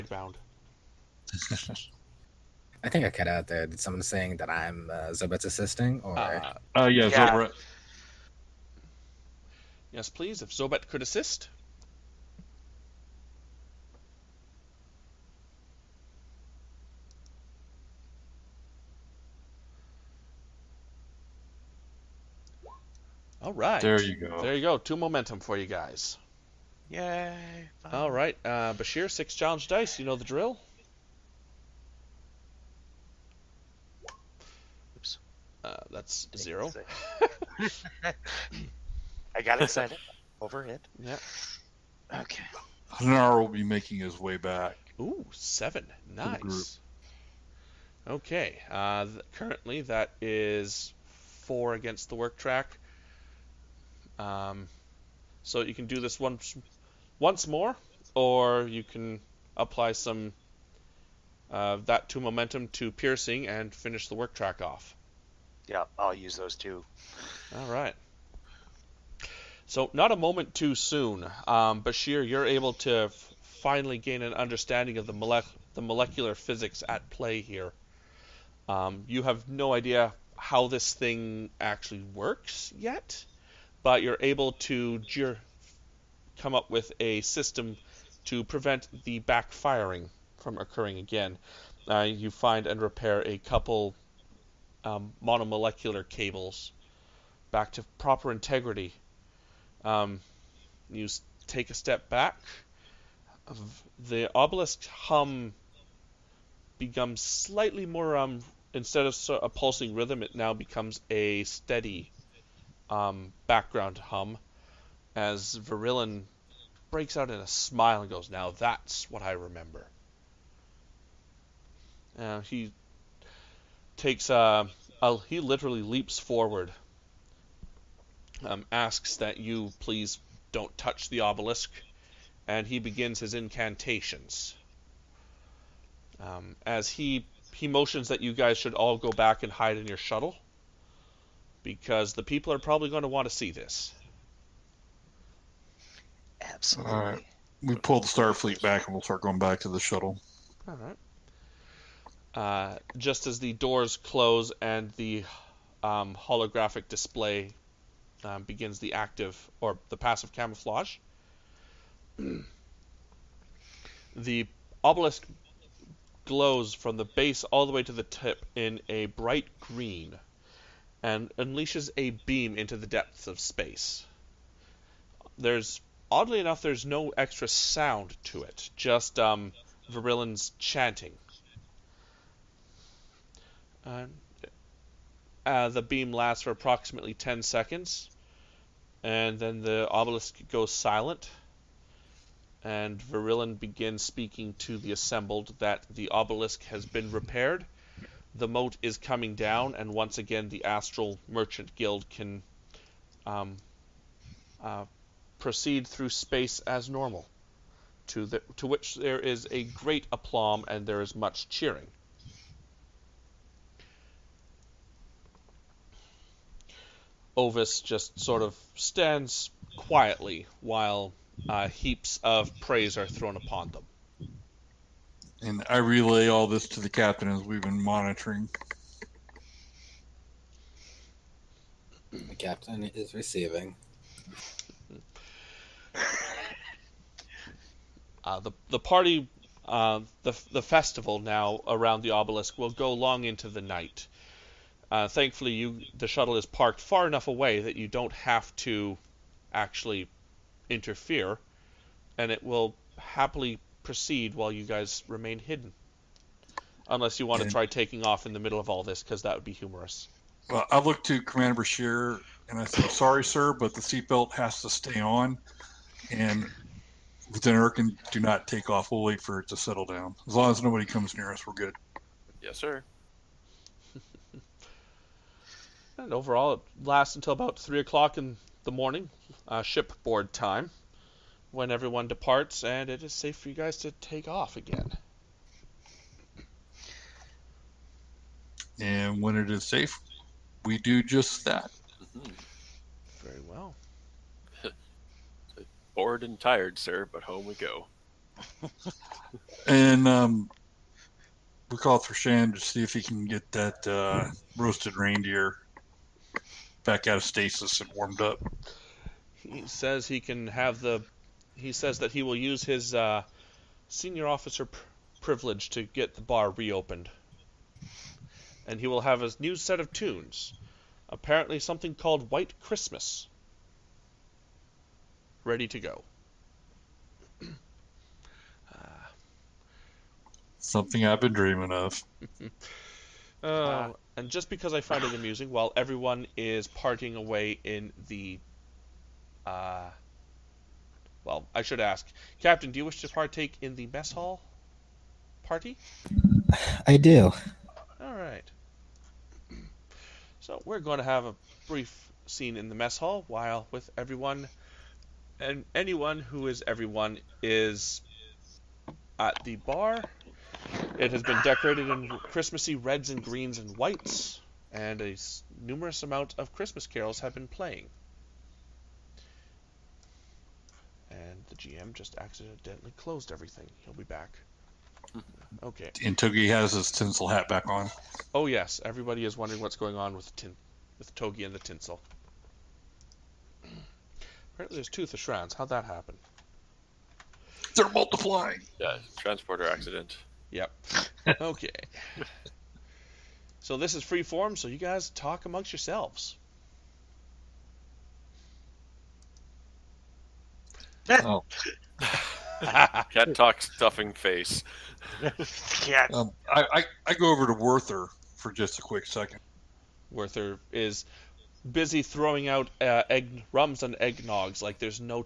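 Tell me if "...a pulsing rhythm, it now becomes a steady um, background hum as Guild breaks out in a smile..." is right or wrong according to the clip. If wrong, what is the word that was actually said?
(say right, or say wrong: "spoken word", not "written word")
wrong: "Verillin", not "Guild".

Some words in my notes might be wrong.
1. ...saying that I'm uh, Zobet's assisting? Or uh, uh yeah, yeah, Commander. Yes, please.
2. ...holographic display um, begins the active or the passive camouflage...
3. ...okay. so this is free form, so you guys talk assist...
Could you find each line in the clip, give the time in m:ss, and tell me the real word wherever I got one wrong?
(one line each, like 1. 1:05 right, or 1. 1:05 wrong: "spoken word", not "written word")
1. 0:04 wrong: "Zobet", not "Commander"
2. 2:36 right
3. 6:31 wrong: "amongst", not "assist".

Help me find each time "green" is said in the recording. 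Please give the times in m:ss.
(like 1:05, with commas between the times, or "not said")
2:49, 6:03.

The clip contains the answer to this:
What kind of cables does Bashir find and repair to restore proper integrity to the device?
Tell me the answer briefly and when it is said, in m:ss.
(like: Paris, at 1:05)
monomolecular cables, at 1:35.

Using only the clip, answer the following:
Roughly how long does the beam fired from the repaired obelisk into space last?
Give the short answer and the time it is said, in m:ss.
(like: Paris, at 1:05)
10 seconds, at 3:07.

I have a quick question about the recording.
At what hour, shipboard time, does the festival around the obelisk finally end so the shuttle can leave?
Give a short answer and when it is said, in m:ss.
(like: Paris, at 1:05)
3 a.m., at 4:37.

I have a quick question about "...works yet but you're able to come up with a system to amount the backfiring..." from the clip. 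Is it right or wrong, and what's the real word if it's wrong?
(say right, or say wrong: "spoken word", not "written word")
wrong: "prevent", not "amount".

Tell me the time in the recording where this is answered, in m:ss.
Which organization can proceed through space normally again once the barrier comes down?
3:20.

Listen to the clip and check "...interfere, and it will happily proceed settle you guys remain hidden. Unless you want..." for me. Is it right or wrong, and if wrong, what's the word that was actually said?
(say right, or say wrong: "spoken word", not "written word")
wrong: "while", not "settle".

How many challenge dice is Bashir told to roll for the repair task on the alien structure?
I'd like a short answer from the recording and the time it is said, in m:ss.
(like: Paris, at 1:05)
6, at 0:29.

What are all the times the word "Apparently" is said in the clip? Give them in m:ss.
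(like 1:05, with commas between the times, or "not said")
5:21, 6:24.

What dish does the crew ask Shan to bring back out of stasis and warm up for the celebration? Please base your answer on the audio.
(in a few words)
roasted reindeer.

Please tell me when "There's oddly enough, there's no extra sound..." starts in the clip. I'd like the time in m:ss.
2:55.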